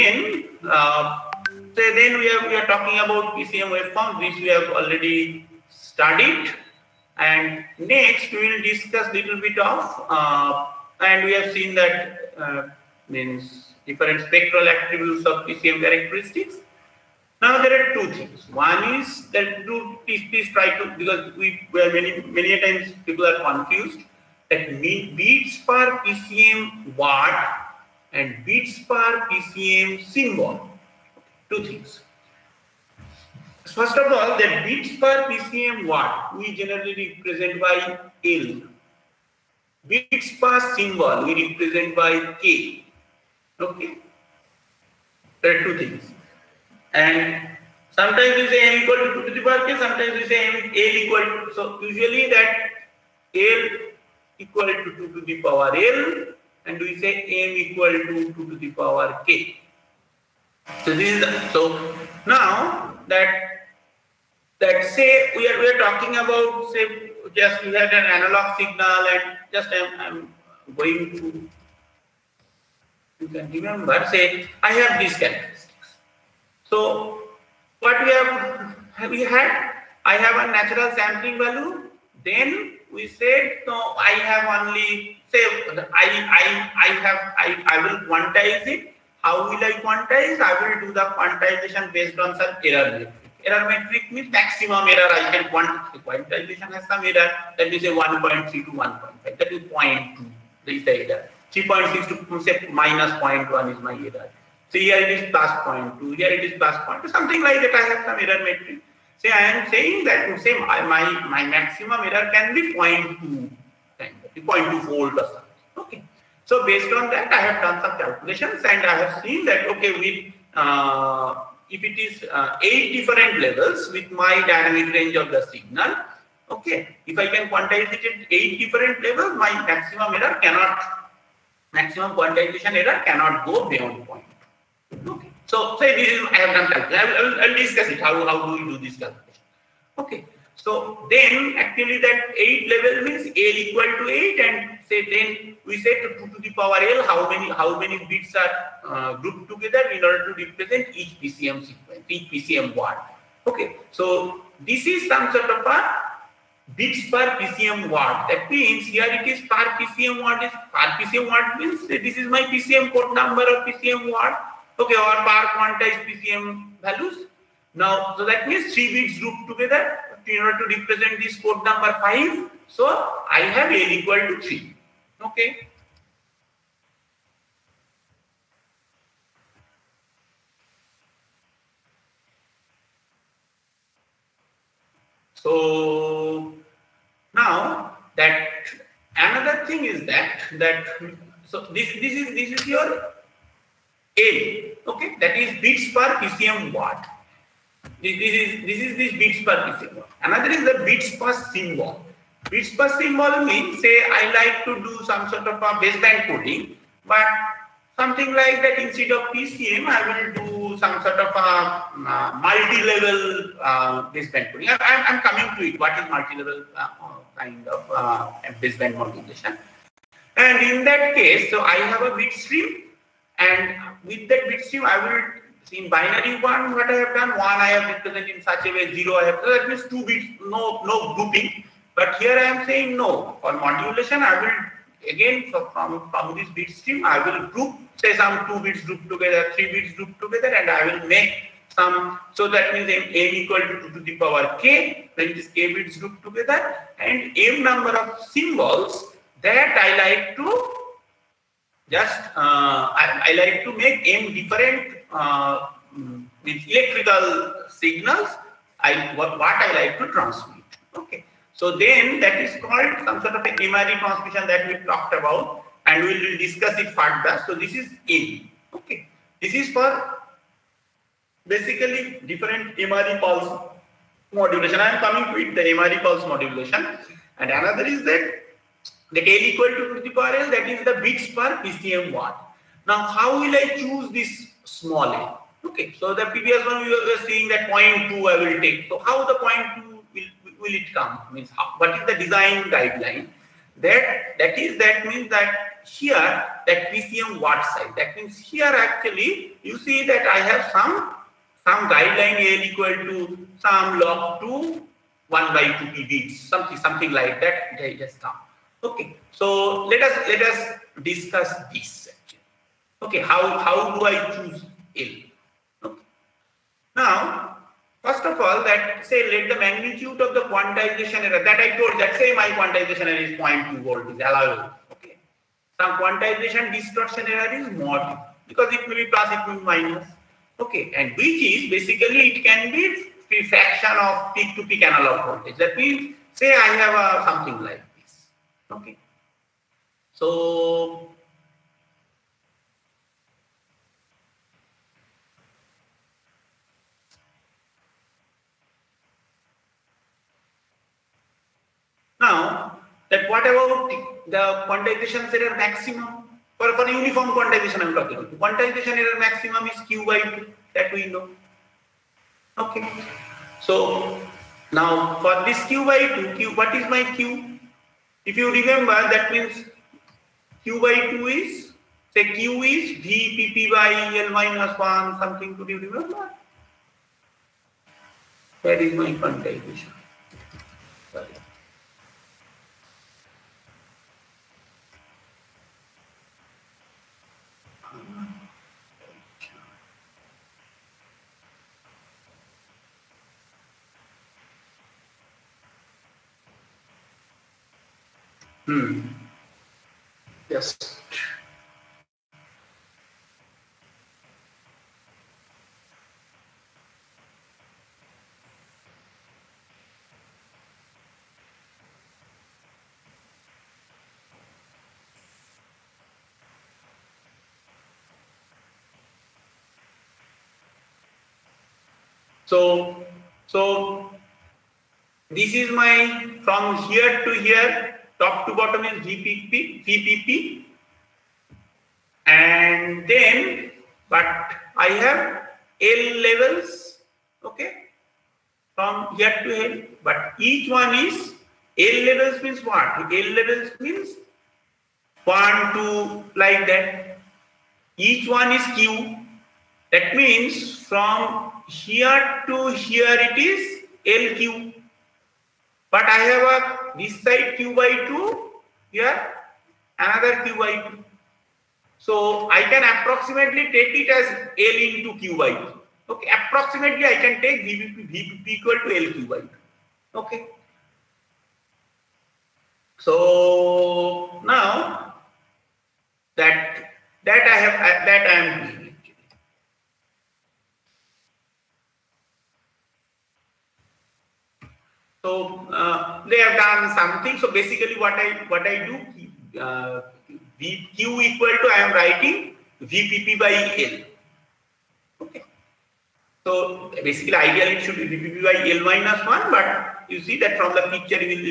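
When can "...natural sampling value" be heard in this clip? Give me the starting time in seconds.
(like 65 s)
80 s.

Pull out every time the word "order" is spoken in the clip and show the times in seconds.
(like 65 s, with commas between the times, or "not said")
150 s, 170 s.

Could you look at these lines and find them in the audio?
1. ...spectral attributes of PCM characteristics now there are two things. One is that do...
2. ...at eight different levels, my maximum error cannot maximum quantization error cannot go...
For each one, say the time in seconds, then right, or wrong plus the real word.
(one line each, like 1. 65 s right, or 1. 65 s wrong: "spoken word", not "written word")
1. 14 s right
2. 128 s right.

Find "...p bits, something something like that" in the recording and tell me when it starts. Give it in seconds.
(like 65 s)
305 s.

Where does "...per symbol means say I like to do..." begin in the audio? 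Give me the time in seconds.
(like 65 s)
202 s.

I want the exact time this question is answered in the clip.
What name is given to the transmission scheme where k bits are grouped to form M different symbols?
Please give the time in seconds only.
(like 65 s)
263 s.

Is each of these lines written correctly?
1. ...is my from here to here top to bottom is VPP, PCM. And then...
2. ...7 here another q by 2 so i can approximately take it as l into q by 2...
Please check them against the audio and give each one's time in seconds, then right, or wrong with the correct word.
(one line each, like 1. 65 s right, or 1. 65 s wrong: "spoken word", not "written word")
1. 425 s wrong: "VPP", not "PCM"
2. 458 s wrong: "2", not "7".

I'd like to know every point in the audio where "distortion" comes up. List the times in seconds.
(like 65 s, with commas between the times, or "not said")
326 s.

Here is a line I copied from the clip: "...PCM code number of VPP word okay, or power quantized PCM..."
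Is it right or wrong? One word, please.
wrong.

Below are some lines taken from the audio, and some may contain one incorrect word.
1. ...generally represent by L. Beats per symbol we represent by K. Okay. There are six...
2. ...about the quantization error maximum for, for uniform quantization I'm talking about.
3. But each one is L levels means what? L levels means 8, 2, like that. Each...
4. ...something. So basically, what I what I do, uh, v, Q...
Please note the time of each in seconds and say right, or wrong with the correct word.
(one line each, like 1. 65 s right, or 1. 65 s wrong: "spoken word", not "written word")
1. 36 s wrong: "two", not "six"
2. 353 s right
3. 440 s wrong: "1", not "8"
4. 486 s right.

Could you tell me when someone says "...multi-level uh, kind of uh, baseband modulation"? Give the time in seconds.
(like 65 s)
216 s.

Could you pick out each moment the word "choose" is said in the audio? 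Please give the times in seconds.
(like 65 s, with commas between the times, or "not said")
283 s, 314 s.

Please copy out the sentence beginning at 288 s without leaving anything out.
So how the 0.2 will, will it come?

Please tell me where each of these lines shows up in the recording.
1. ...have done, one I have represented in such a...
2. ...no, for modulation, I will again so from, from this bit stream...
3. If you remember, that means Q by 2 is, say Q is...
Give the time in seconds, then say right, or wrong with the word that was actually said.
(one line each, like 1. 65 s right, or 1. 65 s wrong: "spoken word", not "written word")
1. 226 s right
2. 232 s right
3. 368 s right.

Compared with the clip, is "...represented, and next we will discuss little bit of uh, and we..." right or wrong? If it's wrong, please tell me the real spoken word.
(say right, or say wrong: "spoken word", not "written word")
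wrong: "studied", not "represented".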